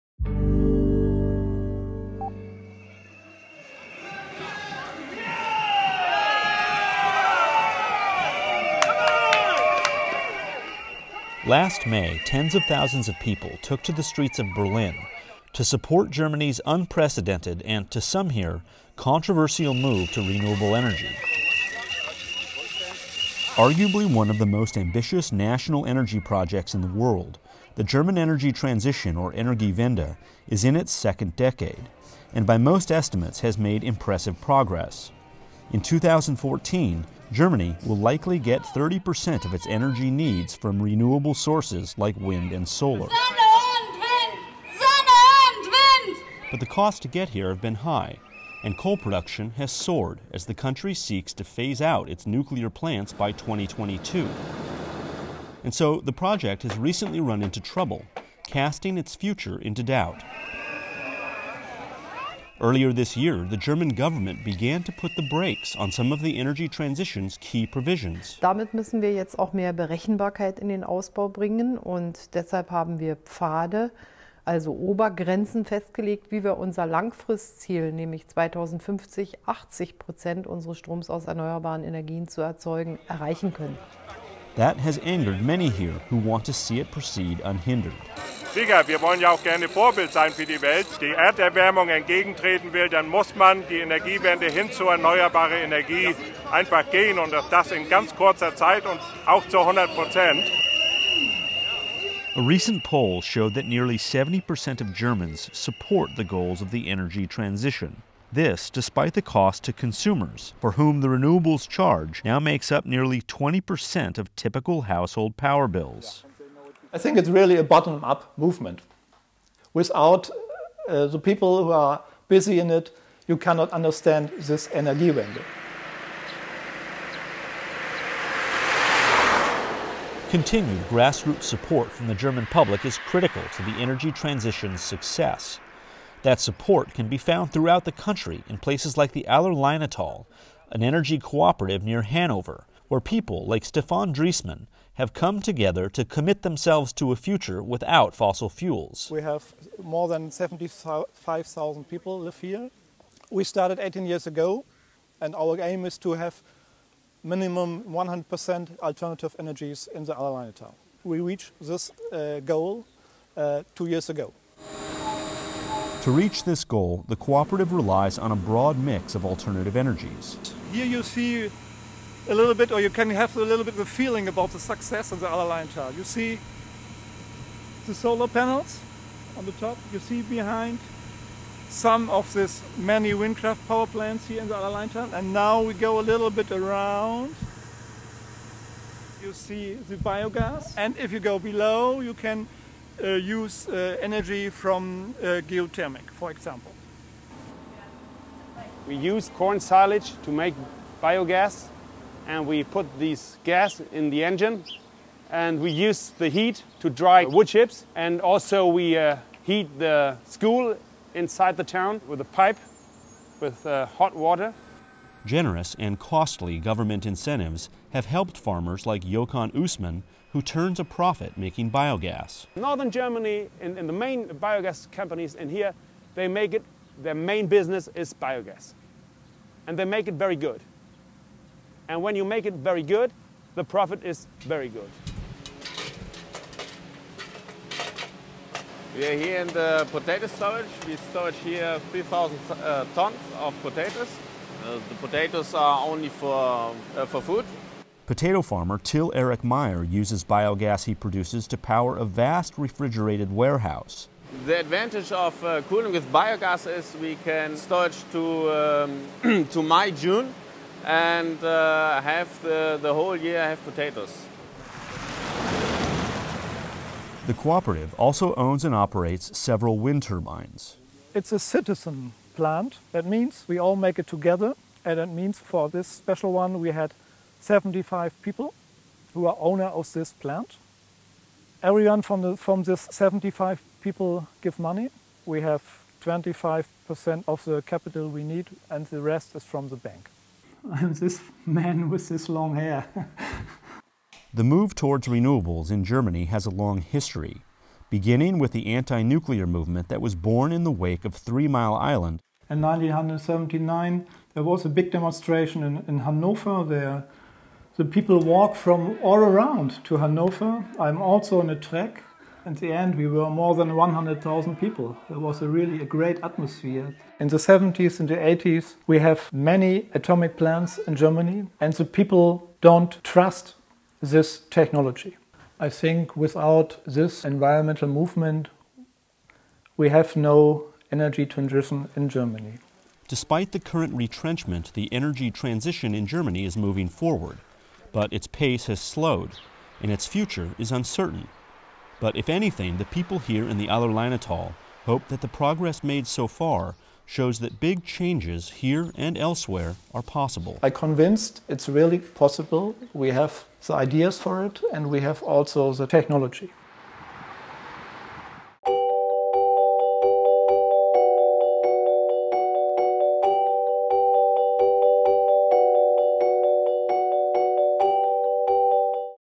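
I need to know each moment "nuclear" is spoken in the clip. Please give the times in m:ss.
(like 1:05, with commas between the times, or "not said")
0:52, 4:59.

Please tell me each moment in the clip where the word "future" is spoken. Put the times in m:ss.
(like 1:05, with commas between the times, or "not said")
0:59, 2:27, 5:40.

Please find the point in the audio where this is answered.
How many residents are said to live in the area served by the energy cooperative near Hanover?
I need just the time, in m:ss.
2:29.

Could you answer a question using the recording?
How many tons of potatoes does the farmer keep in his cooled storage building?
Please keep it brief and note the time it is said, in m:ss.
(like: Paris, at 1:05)
3,000 tons, at 4:01.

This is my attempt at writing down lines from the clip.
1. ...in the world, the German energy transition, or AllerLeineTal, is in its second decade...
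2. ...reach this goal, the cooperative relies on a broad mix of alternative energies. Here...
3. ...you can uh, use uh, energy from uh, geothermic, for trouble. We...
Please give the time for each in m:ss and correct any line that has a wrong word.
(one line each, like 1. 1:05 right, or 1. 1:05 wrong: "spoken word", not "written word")
1. 0:26 wrong: "Energiewende", not "AllerLeineTal"
2. 2:46 right
3. 3:12 wrong: "example", not "trouble".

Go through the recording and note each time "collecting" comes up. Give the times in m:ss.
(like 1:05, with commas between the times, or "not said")
not said.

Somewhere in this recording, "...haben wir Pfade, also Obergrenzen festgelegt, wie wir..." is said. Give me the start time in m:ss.
1:12.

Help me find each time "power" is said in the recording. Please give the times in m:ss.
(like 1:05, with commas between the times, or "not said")
1:55, 3:03, 4:11.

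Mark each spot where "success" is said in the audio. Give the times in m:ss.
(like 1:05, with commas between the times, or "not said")
2:14, 2:54.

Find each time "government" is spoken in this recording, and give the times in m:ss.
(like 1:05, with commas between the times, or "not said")
1:03, 3:36.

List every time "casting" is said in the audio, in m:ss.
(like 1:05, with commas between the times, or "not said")
0:58.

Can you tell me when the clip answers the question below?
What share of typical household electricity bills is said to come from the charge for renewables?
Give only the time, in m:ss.
1:52.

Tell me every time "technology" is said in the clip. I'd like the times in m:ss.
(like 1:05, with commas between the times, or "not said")
5:24, 5:55.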